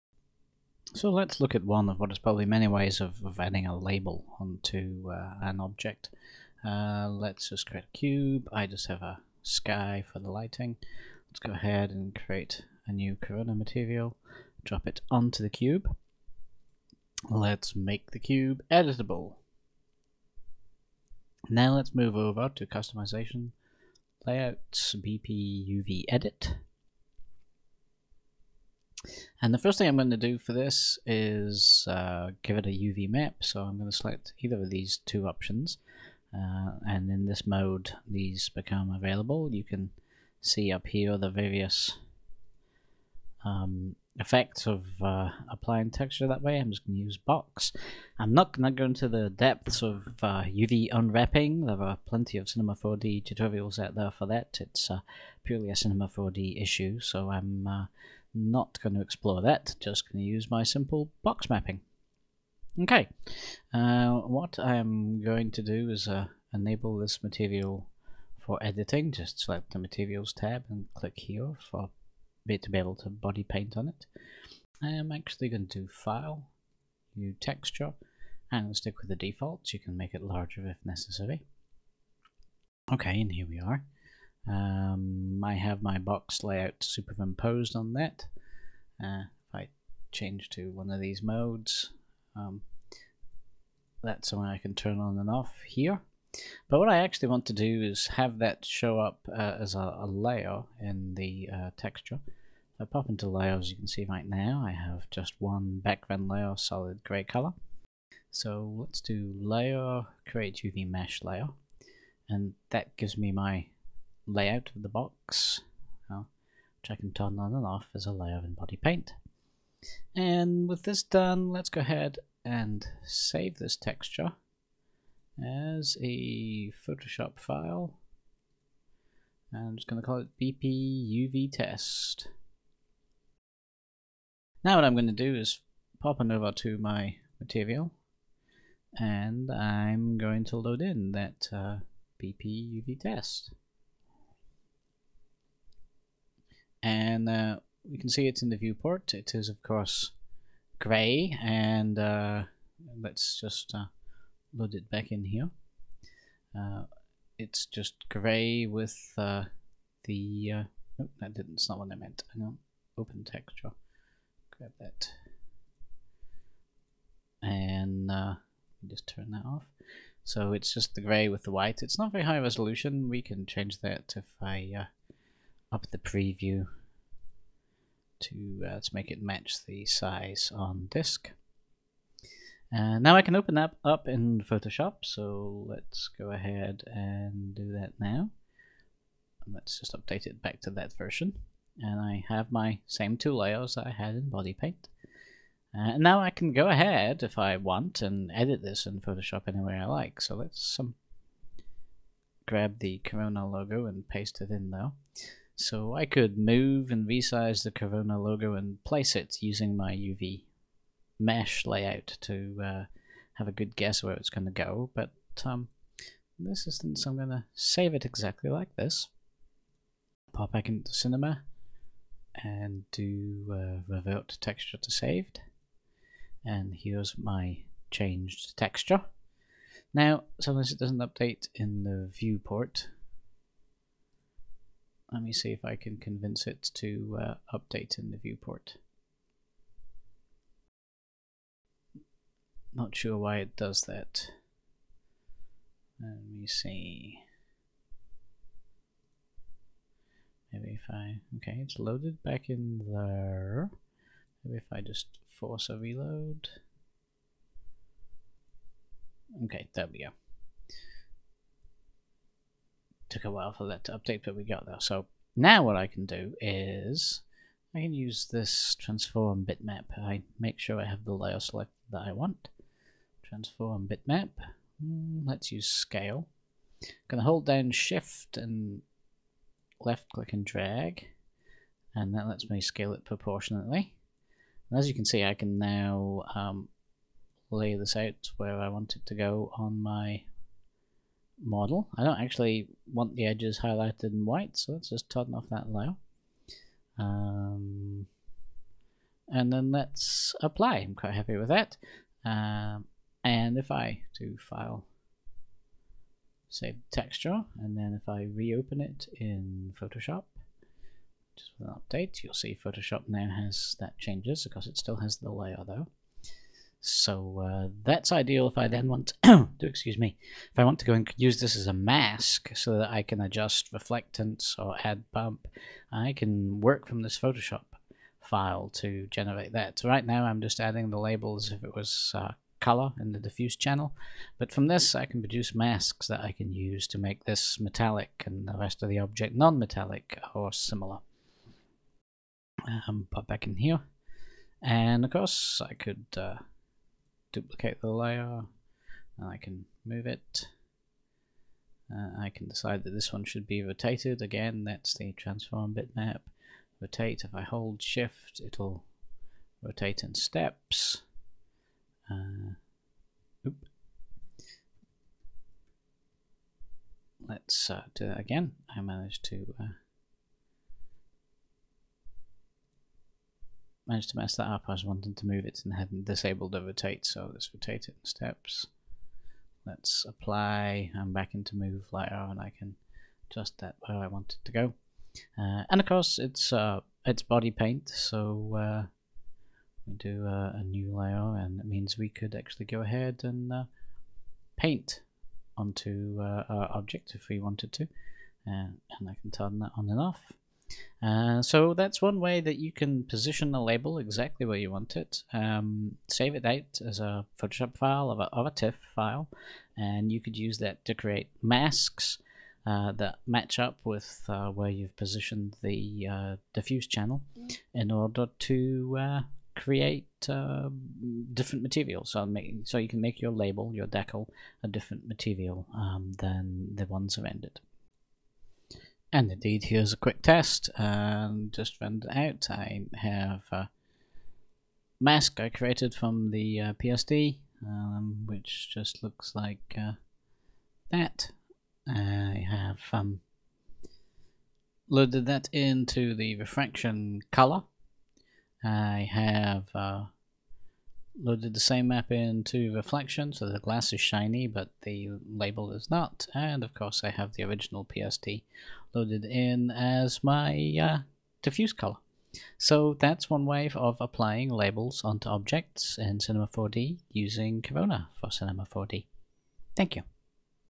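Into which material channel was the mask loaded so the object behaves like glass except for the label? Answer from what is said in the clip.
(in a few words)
Refraction color.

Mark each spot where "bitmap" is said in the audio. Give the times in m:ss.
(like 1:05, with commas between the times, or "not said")
4:29, 4:33, 5:55.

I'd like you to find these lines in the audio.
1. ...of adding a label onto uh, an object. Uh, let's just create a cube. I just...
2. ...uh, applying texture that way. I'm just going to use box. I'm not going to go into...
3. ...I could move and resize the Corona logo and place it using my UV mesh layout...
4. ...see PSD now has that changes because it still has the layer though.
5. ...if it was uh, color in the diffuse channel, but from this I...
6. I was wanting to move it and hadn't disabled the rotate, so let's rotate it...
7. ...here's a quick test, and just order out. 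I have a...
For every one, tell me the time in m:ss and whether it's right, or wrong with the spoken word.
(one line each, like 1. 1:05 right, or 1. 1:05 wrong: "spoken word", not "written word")
1. 0:03 right
2. 0:45 right
3. 3:25 right
4. 5:12 wrong: "Photoshop", not "PSD"
5. 5:31 right
6. 6:14 right
7. 7:09 wrong: "render", not "order".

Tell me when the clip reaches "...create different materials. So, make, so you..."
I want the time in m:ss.
6:59.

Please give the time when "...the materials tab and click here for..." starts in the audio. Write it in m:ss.
1:09.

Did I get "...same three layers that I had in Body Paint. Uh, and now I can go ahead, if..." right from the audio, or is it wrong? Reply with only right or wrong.
wrong.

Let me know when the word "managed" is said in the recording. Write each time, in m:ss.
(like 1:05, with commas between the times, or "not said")
6:08, 6:13.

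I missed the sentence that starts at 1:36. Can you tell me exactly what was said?
But what I actually want to do is have that show up uh, as a, a, layer in the uh, texture.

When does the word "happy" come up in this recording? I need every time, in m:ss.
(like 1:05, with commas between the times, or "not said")
5:01.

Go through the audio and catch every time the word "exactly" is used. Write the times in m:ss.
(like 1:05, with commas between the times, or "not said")
3:38, 6:43.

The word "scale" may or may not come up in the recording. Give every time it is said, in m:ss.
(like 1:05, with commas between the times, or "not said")
4:35, 4:42.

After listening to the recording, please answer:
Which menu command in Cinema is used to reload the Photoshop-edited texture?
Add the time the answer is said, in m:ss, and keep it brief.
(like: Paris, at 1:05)
Revert texture to saved, at 3:43.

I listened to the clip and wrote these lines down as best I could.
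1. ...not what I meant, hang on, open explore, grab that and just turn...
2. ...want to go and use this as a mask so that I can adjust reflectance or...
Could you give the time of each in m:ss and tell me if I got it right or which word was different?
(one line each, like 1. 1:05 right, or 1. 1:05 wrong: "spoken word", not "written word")
1. 2:41 wrong: "texture", not "explore"
2. 5:20 right.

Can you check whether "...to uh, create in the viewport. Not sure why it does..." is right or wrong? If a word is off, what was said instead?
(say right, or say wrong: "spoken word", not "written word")
wrong: "update", not "create".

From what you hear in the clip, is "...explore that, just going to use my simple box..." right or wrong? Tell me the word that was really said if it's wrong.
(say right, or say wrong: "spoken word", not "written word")
right.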